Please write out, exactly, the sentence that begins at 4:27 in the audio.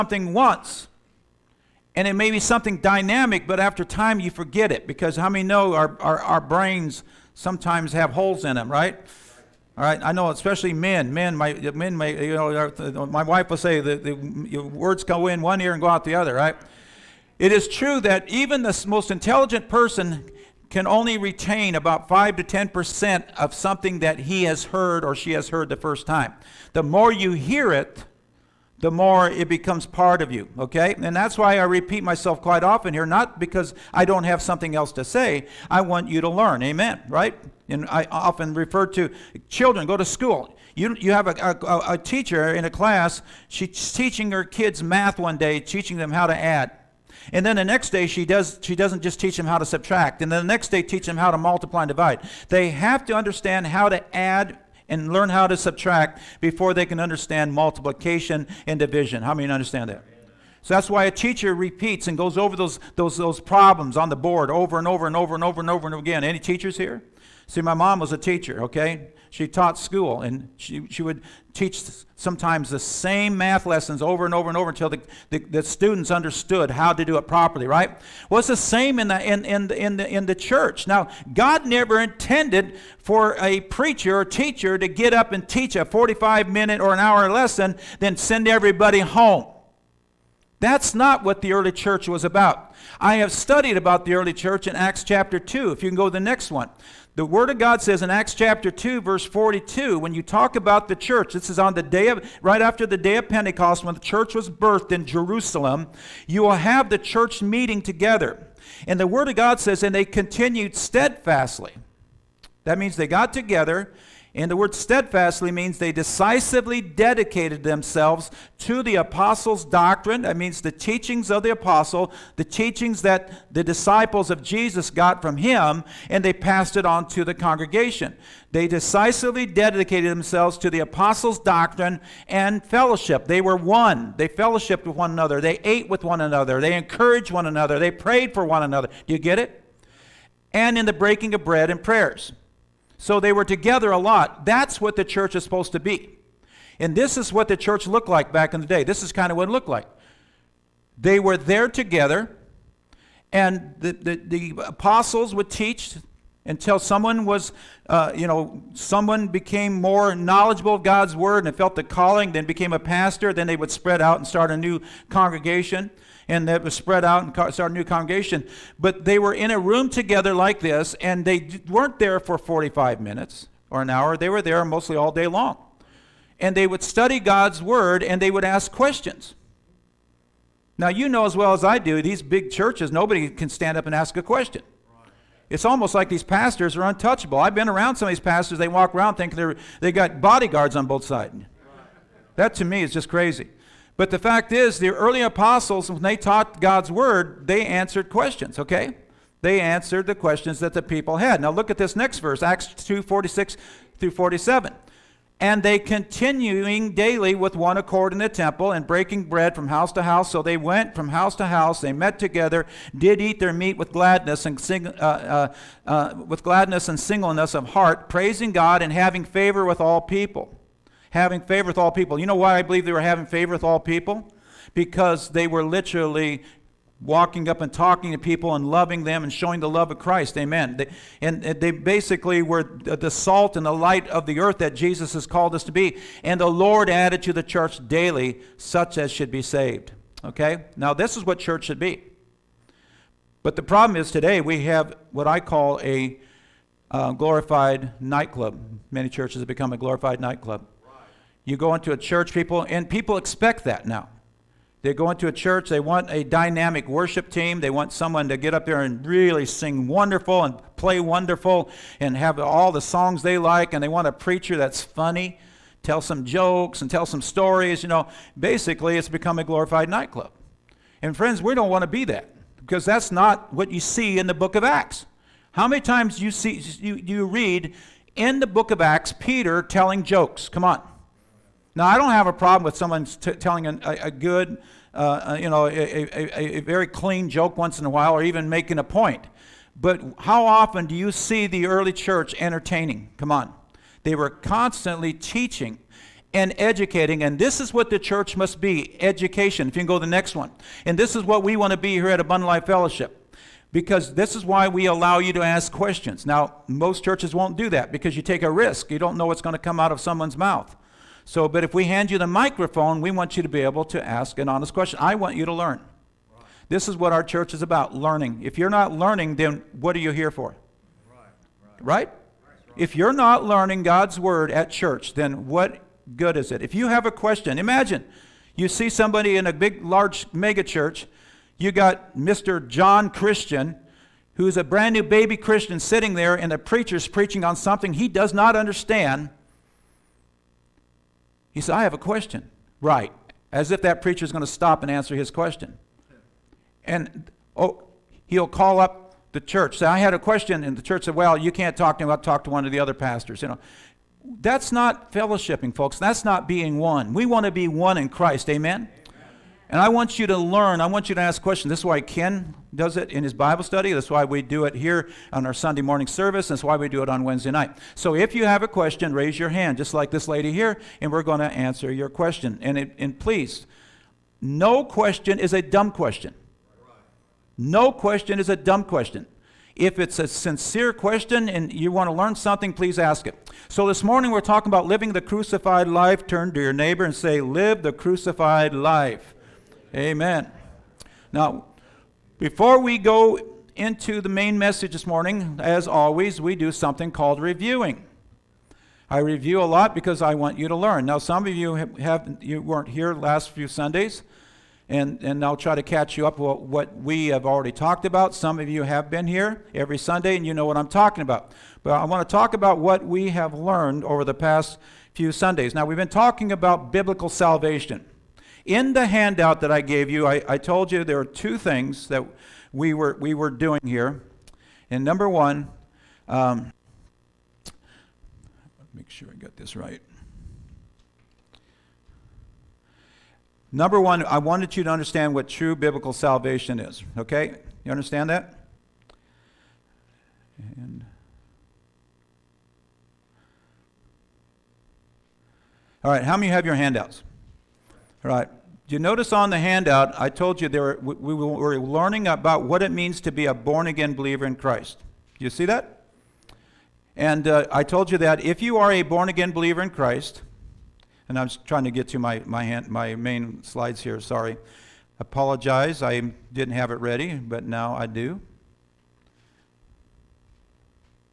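You know, basically, it's become a glorified nightclub.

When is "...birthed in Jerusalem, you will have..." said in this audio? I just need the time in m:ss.
1:44.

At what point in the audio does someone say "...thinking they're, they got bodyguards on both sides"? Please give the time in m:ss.
3:09.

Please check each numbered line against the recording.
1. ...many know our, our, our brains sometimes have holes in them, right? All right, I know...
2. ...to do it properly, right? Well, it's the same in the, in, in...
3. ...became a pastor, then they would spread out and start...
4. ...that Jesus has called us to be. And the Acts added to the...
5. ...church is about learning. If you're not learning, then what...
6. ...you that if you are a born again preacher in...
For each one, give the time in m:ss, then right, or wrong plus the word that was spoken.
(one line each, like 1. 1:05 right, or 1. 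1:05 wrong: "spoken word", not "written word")
1. 0:05 right
2. 1:16 right
3. 2:42 right
4. 3:54 wrong: "Lord", not "Acts"
5. 5:17 right
6. 7:38 wrong: "believer", not "preacher".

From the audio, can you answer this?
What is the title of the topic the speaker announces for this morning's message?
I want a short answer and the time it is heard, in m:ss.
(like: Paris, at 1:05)
Living the crucified life, at 6:24.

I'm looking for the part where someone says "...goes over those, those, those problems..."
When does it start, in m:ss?
1:02.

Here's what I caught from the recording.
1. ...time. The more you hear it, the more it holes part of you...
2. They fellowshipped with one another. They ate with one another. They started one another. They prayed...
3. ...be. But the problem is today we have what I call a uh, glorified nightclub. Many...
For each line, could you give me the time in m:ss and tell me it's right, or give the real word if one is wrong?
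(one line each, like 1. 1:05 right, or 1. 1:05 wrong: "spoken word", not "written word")
1. 0:26 wrong: "becomes", not "holes"
2. 2:14 wrong: "encouraged", not "started"
3. 4:01 right.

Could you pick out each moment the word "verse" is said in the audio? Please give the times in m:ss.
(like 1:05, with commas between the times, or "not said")
1:39, 3:22.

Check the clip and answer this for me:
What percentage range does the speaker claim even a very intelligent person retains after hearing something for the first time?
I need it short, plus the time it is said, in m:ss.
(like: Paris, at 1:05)
5 to 10%, at 0:22.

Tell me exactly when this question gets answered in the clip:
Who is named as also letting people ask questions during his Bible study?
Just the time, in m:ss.
6:02.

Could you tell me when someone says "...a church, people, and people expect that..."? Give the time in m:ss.
4:11.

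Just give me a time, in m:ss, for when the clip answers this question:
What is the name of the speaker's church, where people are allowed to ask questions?
5:02.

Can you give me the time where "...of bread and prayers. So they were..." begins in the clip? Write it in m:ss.
2:21.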